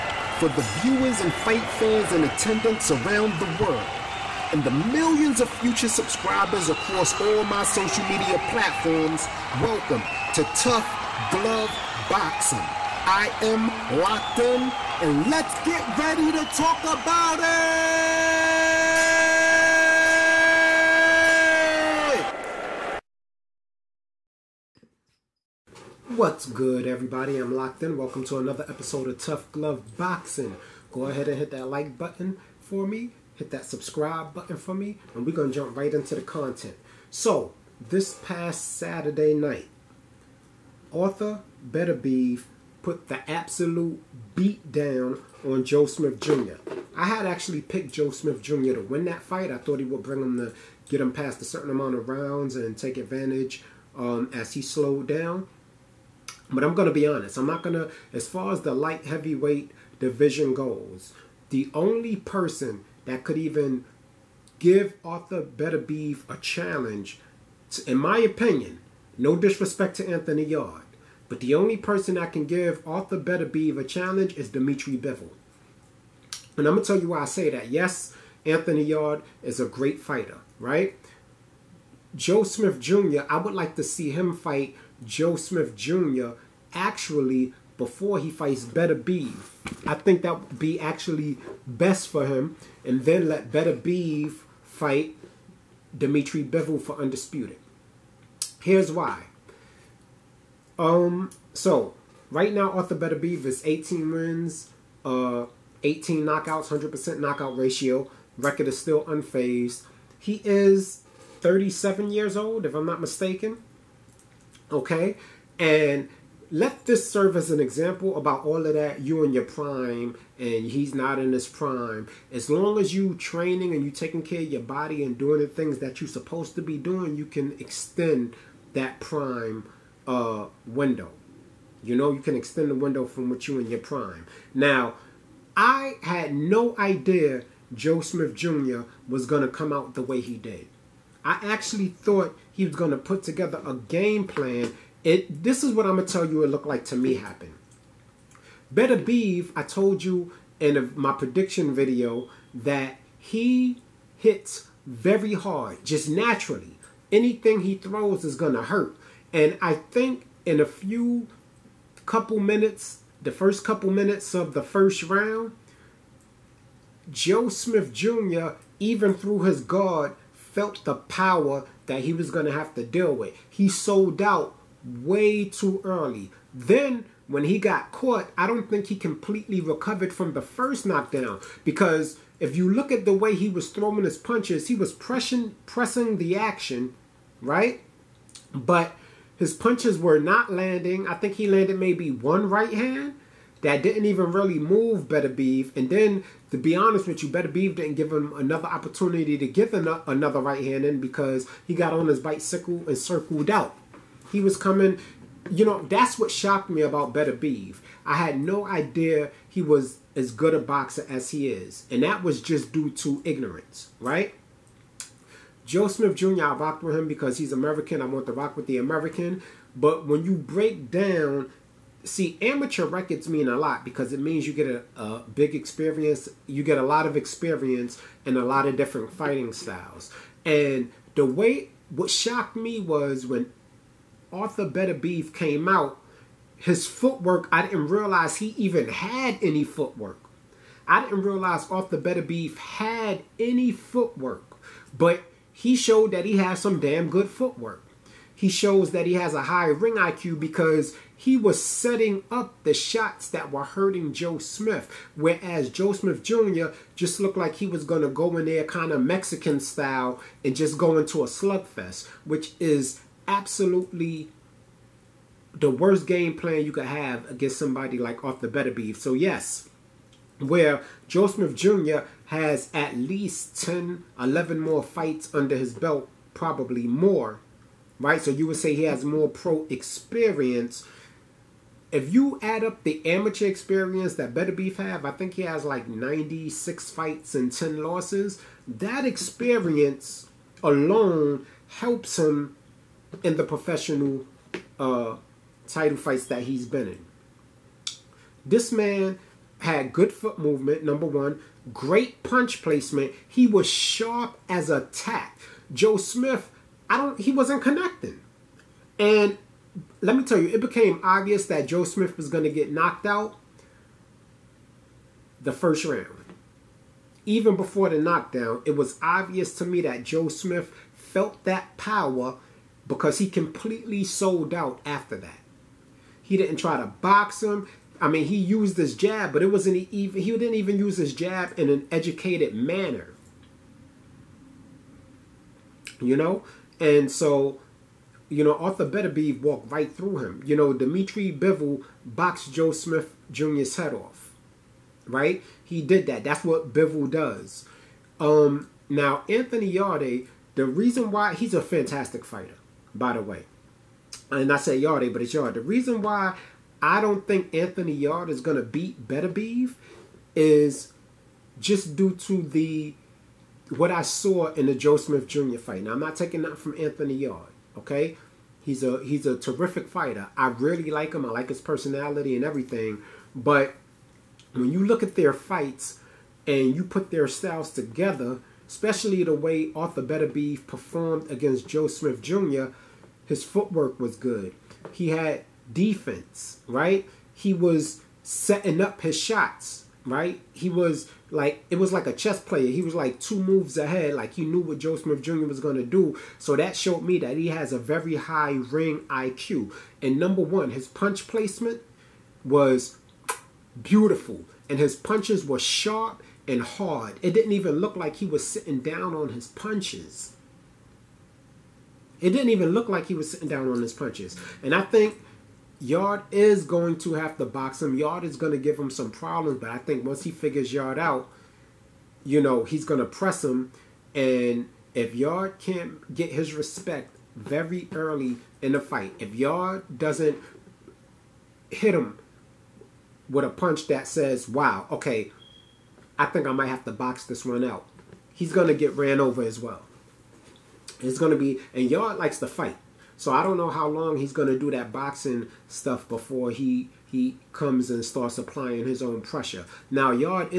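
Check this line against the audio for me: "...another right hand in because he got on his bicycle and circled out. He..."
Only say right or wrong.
right.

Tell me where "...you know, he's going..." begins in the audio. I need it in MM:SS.
07:02.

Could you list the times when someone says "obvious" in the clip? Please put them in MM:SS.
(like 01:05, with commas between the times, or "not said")
05:11, 05:19.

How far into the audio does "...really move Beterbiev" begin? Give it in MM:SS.
03:14.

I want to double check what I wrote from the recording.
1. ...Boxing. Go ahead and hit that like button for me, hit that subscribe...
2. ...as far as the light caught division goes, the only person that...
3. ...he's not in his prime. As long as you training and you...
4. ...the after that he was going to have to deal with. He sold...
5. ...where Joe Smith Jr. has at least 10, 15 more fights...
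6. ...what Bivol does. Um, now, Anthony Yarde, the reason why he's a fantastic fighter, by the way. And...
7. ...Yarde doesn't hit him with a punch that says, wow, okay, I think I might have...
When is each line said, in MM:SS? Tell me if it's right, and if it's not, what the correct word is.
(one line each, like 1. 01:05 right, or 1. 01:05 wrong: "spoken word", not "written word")
1. 00:29 right
2. 00:58 wrong: "heavyweight", not "caught"
3. 02:00 right
4. 02:50 wrong: "power", not "after"
5. 04:30 wrong: "11", not "15"
6. 05:46 right
7. 07:09 right.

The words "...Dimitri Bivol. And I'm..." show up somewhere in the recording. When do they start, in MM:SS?
01:14.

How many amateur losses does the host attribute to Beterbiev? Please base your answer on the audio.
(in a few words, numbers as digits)
10.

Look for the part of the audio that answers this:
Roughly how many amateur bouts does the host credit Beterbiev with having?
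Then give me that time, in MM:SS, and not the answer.
04:45.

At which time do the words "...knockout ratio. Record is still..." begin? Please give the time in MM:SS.
01:47.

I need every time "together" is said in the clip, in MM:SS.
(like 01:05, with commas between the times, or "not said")
02:23, 06:17.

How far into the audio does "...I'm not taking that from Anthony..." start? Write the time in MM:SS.
06:05.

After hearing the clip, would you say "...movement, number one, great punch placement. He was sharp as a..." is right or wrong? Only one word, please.
right.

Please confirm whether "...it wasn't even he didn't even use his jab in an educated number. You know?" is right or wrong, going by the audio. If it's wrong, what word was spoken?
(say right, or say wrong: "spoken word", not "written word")
wrong: "manner", not "number".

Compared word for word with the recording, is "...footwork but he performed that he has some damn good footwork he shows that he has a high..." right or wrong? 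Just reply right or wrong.
wrong.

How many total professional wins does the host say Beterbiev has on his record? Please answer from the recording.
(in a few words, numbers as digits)
18.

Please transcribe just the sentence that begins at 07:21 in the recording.
It's going to be, and Yarde likes to fight.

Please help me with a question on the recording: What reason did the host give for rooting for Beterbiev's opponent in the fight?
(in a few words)
He's American.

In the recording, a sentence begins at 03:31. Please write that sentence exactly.
And that was just due to ignorance, right?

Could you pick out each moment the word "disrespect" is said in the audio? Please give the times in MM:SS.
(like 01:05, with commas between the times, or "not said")
01:09.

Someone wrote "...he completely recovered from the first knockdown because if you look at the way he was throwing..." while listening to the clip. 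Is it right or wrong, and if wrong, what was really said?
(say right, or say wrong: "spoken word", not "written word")
right.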